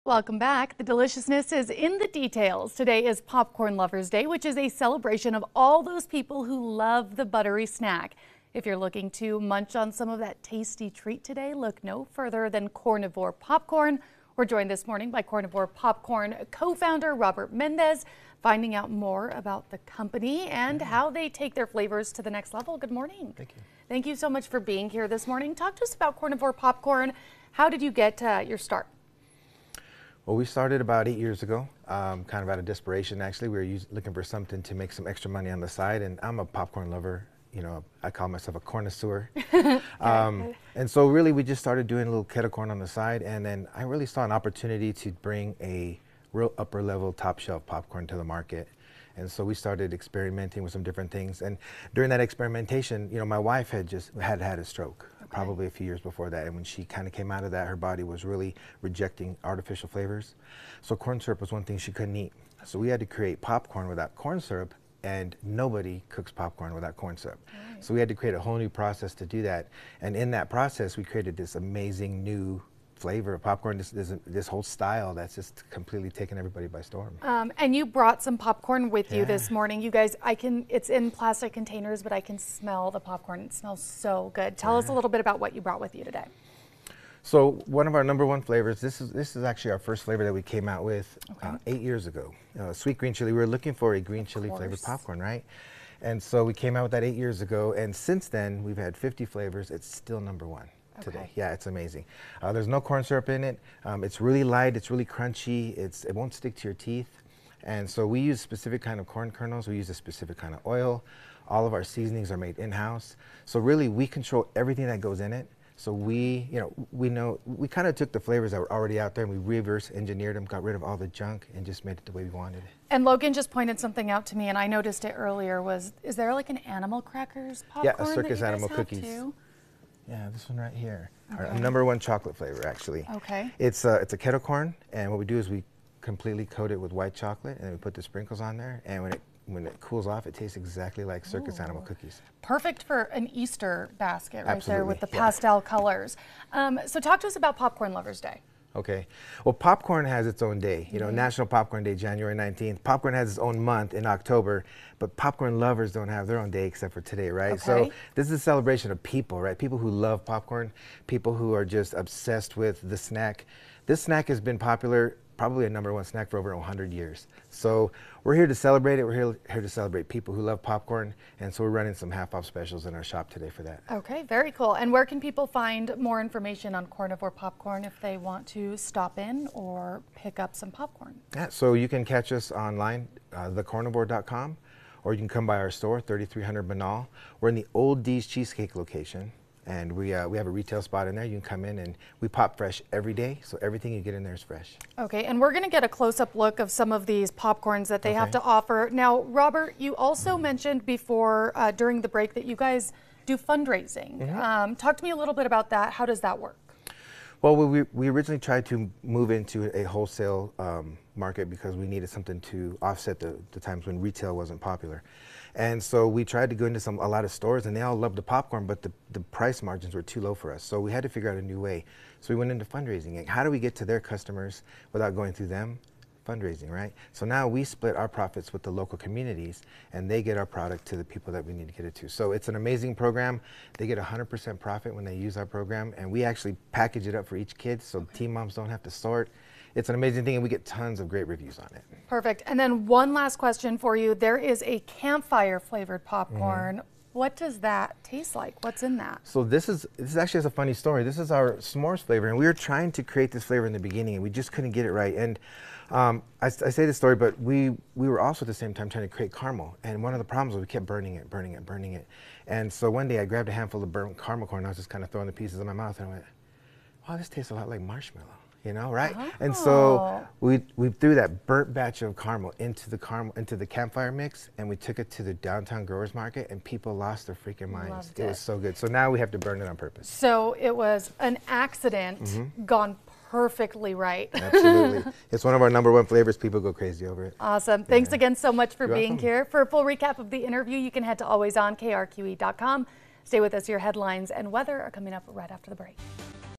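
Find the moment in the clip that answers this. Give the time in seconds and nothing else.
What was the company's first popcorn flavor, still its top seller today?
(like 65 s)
92 s.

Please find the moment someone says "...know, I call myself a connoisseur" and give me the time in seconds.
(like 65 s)
37 s.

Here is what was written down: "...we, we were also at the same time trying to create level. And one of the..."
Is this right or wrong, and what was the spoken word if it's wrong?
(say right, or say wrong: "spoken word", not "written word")
wrong: "caramel", not "level".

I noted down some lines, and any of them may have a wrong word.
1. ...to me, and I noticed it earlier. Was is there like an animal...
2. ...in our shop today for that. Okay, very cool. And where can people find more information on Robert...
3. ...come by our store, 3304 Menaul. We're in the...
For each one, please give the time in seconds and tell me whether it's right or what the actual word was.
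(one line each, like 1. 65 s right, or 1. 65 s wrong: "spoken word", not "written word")
1. 124 s right
2. 172 s wrong: "Cornivore", not "Robert"
3. 185 s wrong: "3300", not "3304".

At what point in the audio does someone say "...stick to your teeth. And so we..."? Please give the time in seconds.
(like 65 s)
106 s.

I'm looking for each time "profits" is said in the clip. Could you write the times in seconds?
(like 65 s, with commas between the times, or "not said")
228 s, 234 s.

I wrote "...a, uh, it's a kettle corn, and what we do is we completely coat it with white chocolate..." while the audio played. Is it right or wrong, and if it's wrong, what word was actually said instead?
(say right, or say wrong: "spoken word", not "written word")
right.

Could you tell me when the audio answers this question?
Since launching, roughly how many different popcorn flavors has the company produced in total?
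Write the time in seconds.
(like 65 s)
98 s.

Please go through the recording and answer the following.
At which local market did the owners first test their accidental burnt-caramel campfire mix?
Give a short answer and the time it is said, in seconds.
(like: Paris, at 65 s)
Downtown growers market, at 275 s.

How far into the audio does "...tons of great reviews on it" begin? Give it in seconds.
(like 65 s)
240 s.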